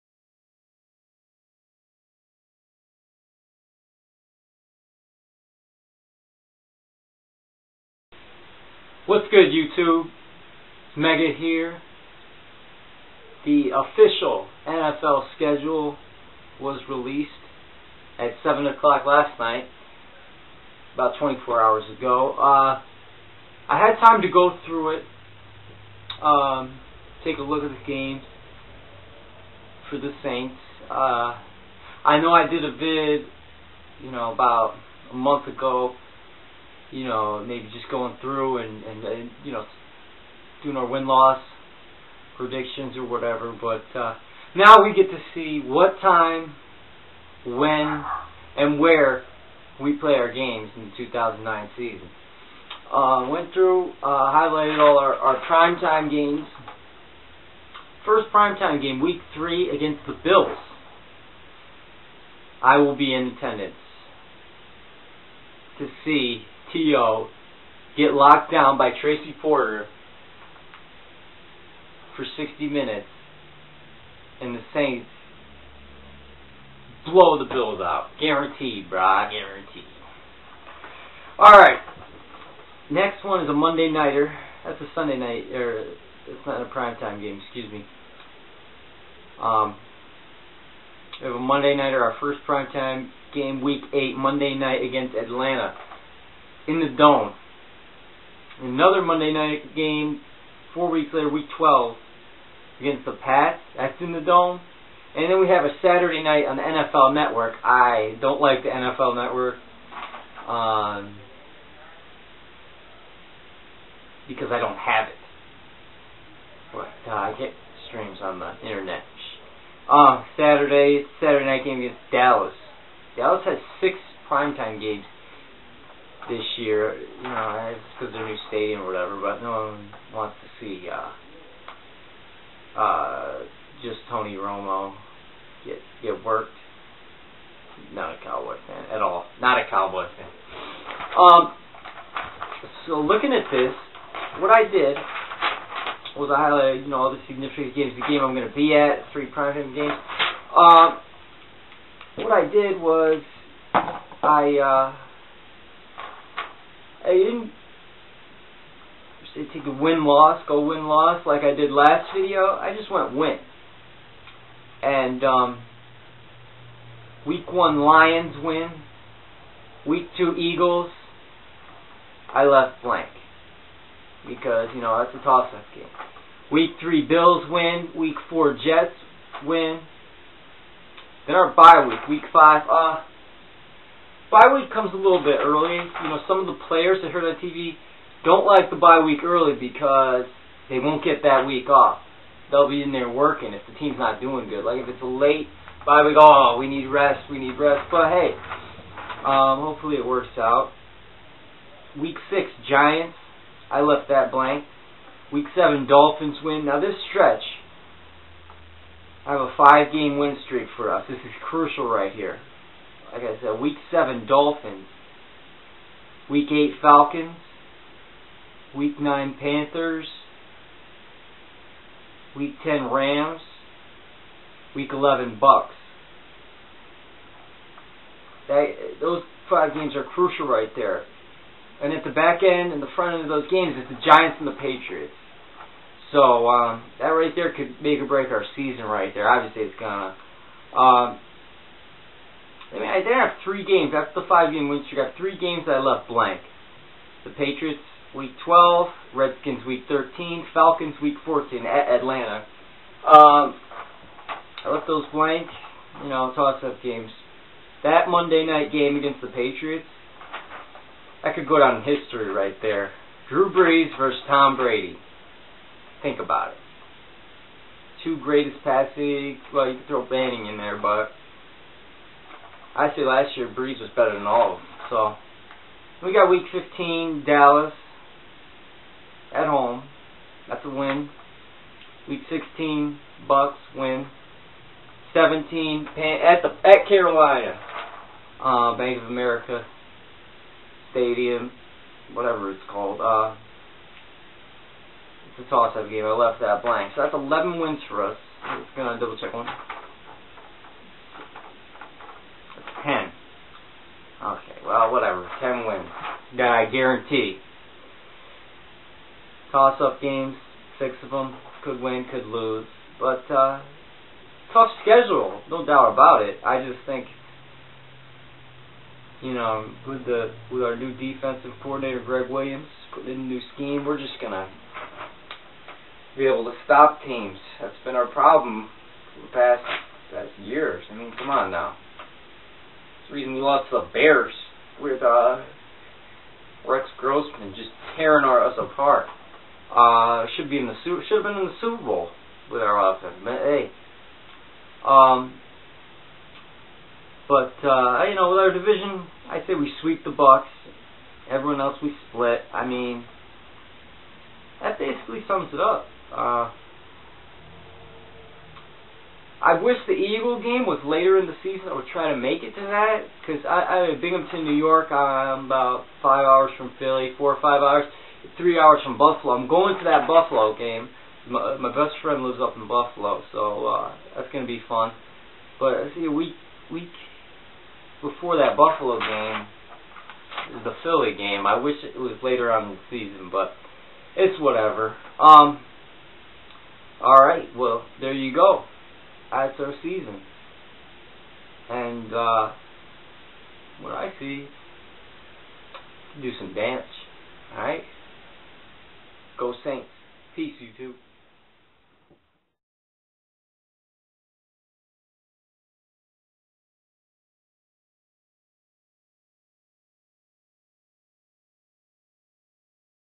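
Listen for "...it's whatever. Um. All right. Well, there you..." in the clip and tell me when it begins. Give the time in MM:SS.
06:24.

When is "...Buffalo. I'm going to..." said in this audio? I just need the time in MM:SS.
06:09.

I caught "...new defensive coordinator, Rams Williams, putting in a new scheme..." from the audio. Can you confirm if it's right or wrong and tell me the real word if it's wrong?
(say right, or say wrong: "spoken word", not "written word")
wrong: "Gregg", not "Rams".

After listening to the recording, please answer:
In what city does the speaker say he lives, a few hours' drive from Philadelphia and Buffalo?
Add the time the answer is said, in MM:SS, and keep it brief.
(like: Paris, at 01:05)
Binghamton, New York, at 06:04.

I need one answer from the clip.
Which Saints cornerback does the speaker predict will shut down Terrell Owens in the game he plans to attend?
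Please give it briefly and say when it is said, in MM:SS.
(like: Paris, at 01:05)
Tracy Porter, at 01:09.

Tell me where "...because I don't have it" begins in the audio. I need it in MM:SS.
01:54.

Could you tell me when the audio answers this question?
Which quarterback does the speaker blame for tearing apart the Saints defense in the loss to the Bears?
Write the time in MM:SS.
05:36.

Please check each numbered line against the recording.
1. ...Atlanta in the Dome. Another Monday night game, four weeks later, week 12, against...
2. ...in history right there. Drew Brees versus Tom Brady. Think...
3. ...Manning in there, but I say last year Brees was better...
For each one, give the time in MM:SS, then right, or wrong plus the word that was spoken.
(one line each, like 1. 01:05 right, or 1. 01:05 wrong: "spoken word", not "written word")
1. 01:35 right
2. 04:21 right
3. 04:30 right.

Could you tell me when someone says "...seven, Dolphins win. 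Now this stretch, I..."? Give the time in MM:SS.
03:25.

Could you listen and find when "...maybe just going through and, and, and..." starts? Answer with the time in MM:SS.
00:37.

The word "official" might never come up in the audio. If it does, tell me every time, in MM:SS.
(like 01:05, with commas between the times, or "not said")
00:13.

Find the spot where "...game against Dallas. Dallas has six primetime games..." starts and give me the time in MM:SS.
02:01.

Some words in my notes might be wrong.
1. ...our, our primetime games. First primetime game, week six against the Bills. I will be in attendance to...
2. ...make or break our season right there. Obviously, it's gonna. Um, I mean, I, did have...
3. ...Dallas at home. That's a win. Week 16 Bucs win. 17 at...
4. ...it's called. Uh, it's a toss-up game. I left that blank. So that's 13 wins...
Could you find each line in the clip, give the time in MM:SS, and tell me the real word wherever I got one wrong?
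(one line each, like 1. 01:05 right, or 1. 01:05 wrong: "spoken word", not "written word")
1. 00:54 wrong: "three", not "six"
2. 03:57 right
3. 04:37 right
4. 04:52 wrong: "11", not "13".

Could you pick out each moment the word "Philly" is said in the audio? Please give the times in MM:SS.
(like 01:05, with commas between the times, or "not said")
06:06, 06:20.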